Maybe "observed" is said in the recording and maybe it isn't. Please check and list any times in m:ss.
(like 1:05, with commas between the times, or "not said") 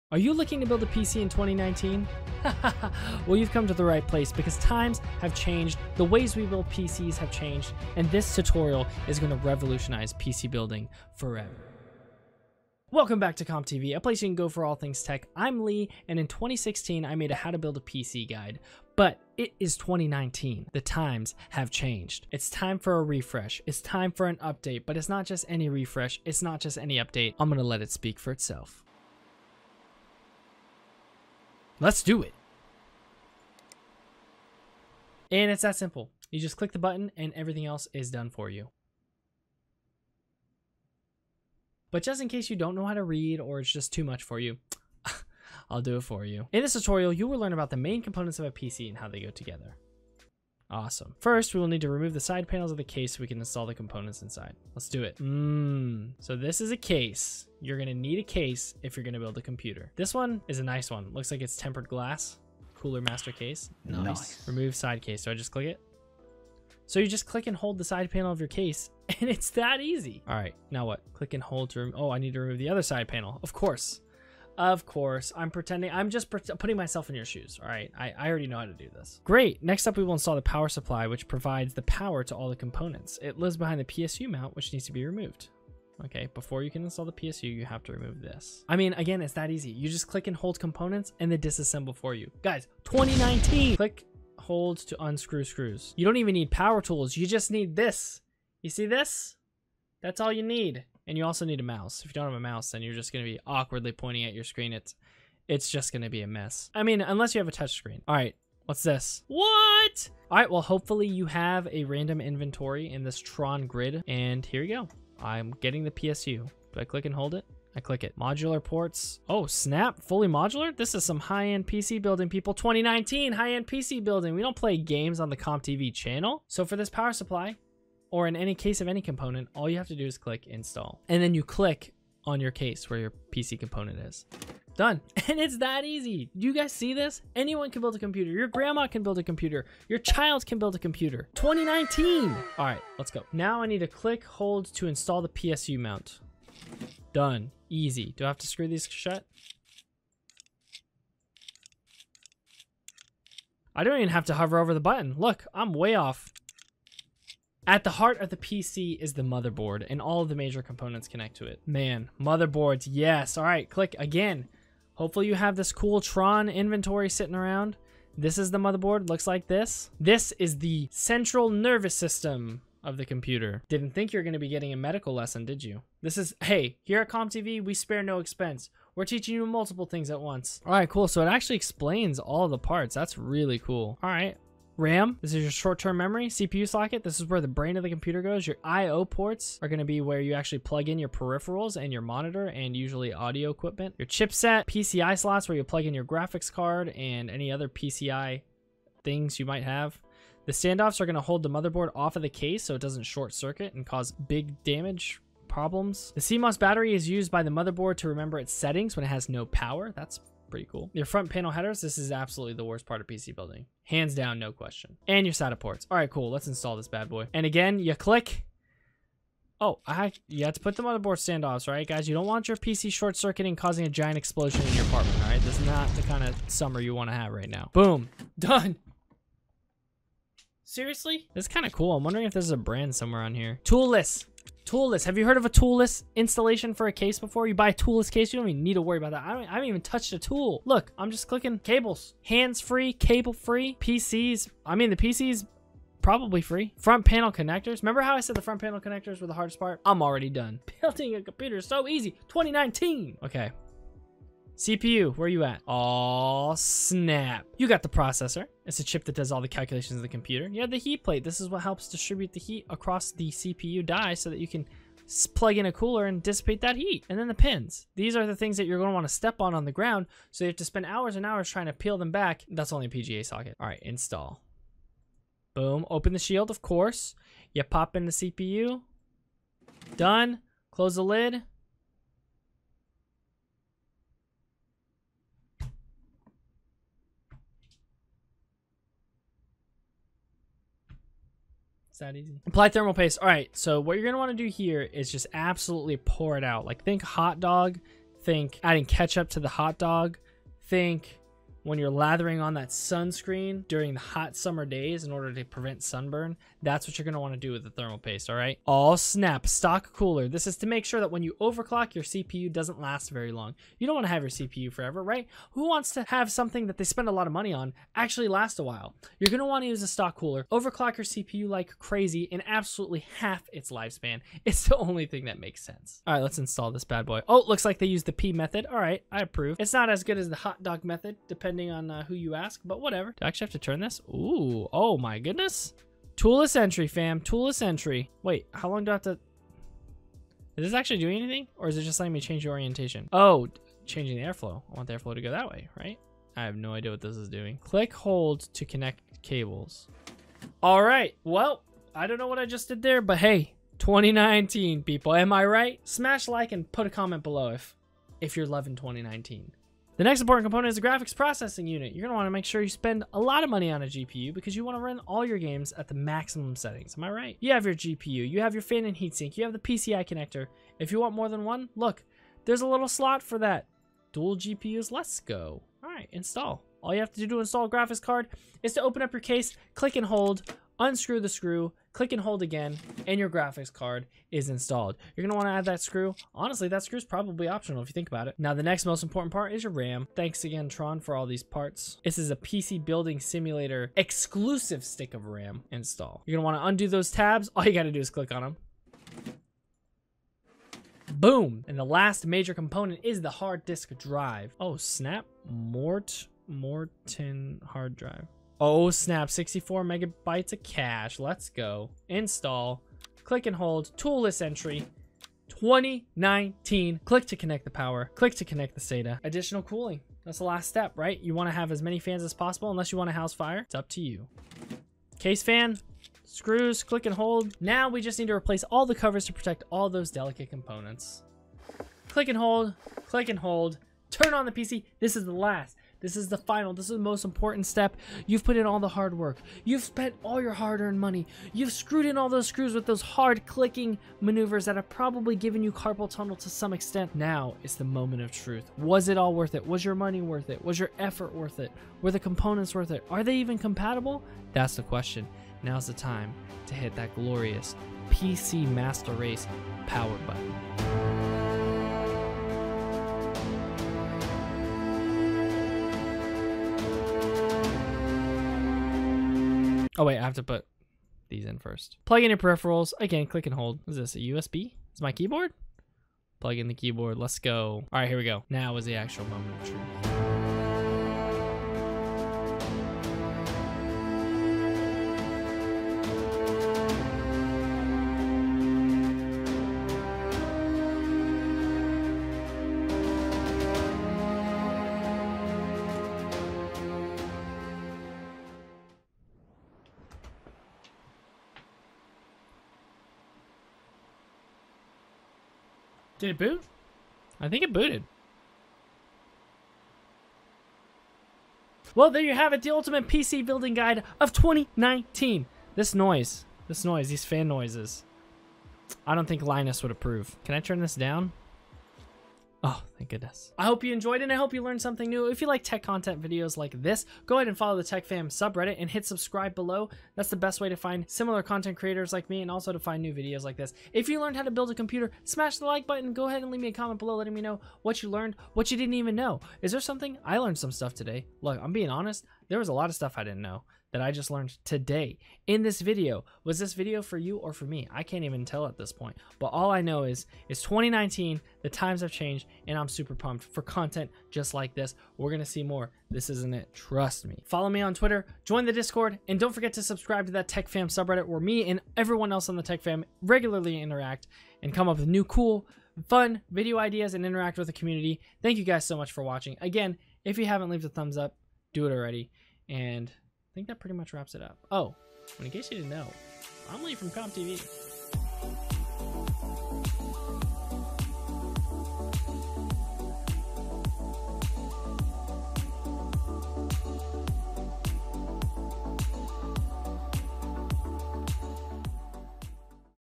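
not said.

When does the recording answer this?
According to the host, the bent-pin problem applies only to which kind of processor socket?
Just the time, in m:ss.
4:32.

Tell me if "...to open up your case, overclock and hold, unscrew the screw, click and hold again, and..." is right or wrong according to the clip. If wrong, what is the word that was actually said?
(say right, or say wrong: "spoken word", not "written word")
wrong: "click", not "overclock".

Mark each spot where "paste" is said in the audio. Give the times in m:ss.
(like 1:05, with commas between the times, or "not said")
4:52, 5:07.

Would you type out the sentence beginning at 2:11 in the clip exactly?
And then you click on your case where your PC component is.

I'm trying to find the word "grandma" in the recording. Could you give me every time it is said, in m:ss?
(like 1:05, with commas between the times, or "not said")
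2:18.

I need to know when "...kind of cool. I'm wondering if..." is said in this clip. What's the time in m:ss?
3:51.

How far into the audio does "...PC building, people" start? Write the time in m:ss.
2:01.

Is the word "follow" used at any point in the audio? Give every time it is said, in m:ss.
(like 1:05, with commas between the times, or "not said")
8:47, 9:17.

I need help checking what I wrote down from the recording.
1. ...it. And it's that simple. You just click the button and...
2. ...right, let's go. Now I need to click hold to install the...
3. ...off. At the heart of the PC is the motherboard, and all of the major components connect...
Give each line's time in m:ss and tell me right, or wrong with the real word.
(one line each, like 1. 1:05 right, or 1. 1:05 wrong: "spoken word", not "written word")
1. 0:32 right
2. 2:22 right
3. 2:35 right.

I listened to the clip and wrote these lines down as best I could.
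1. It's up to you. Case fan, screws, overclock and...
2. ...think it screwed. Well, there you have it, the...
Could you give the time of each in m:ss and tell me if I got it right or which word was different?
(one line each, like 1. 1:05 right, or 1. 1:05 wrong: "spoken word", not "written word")
1. 7:03 wrong: "click", not "overclock"
2. 8:27 wrong: "booted", not "screwed".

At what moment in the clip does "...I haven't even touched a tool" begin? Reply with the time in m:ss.
3:59.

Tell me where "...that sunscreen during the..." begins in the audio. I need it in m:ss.
5:02.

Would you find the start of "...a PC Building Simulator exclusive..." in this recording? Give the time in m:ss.
6:32.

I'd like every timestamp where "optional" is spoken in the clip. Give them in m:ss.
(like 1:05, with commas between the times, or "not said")
6:27.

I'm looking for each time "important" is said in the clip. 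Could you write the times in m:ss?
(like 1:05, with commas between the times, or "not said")
6:00, 6:29, 7:17.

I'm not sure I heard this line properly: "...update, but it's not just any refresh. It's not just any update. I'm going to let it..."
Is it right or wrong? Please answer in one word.
right.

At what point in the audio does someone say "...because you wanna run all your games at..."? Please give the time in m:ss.
6:04.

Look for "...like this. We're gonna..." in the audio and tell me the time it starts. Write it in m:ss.
9:14.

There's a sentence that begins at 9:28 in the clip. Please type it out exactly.
Thank you guys so much for watching.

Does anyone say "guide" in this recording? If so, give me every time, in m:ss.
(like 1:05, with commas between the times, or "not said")
0:18, 8:33.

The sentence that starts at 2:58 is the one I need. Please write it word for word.
We're teaching you multiple things at once.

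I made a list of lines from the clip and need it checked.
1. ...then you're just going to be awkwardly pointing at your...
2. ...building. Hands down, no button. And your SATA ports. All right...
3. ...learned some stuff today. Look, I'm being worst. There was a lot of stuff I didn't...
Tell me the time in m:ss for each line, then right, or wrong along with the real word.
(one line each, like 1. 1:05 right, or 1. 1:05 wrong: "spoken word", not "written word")
1. 1:42 right
2. 3:33 wrong: "question", not "button"
3. 9:00 wrong: "honest", not "worst".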